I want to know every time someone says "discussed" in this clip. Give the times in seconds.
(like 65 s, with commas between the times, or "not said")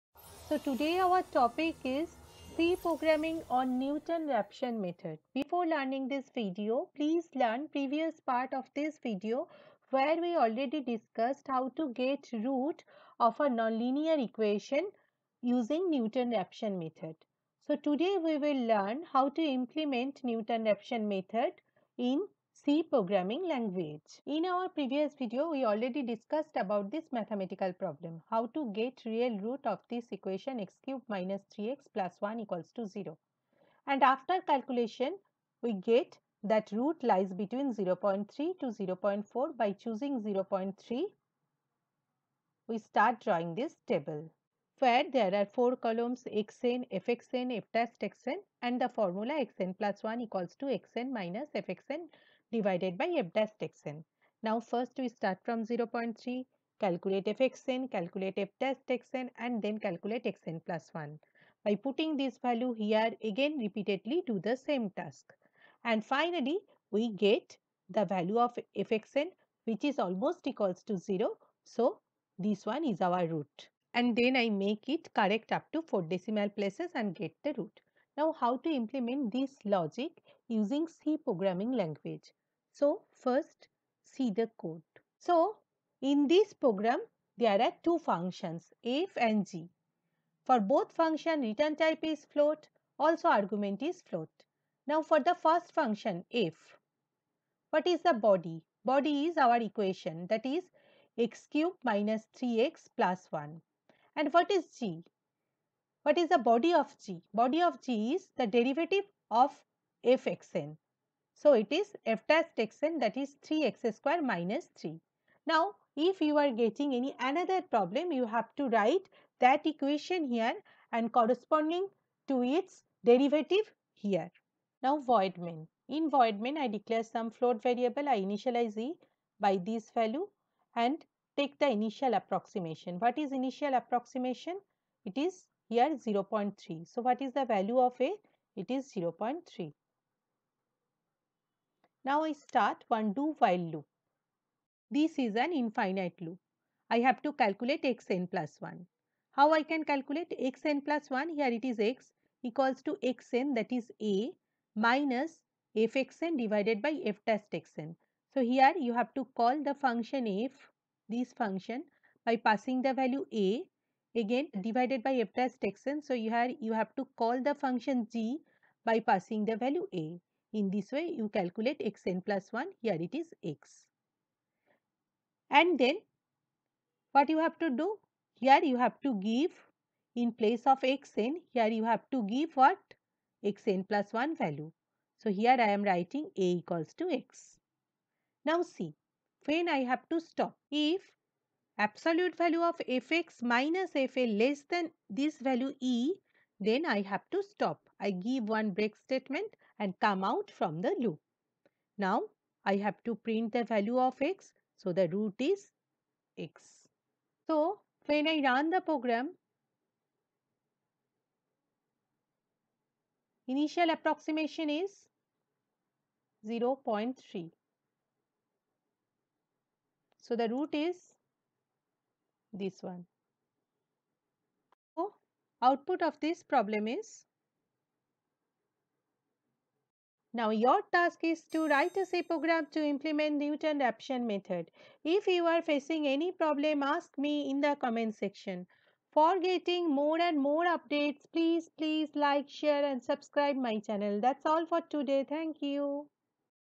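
10 s, 26 s.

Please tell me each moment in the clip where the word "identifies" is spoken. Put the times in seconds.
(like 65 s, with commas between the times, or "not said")
not said.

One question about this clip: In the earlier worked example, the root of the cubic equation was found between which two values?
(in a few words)
0.3 to 0.4.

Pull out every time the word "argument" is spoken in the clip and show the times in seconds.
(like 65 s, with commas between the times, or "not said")
93 s.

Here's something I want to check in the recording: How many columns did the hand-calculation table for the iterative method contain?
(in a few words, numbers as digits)
4.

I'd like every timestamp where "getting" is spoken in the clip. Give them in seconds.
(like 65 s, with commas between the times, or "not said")
116 s, 239 s.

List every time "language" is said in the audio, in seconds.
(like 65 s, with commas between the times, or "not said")
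23 s, 81 s.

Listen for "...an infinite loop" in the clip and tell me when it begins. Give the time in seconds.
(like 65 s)
145 s.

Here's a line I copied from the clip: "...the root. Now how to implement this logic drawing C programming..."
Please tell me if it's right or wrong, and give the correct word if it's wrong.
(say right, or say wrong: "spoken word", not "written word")
wrong: "using", not "drawing".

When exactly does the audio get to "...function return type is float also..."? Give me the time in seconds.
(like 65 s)
90 s.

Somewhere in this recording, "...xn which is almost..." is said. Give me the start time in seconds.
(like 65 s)
68 s.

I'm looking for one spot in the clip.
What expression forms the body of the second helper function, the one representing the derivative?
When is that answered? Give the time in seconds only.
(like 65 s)
113 s.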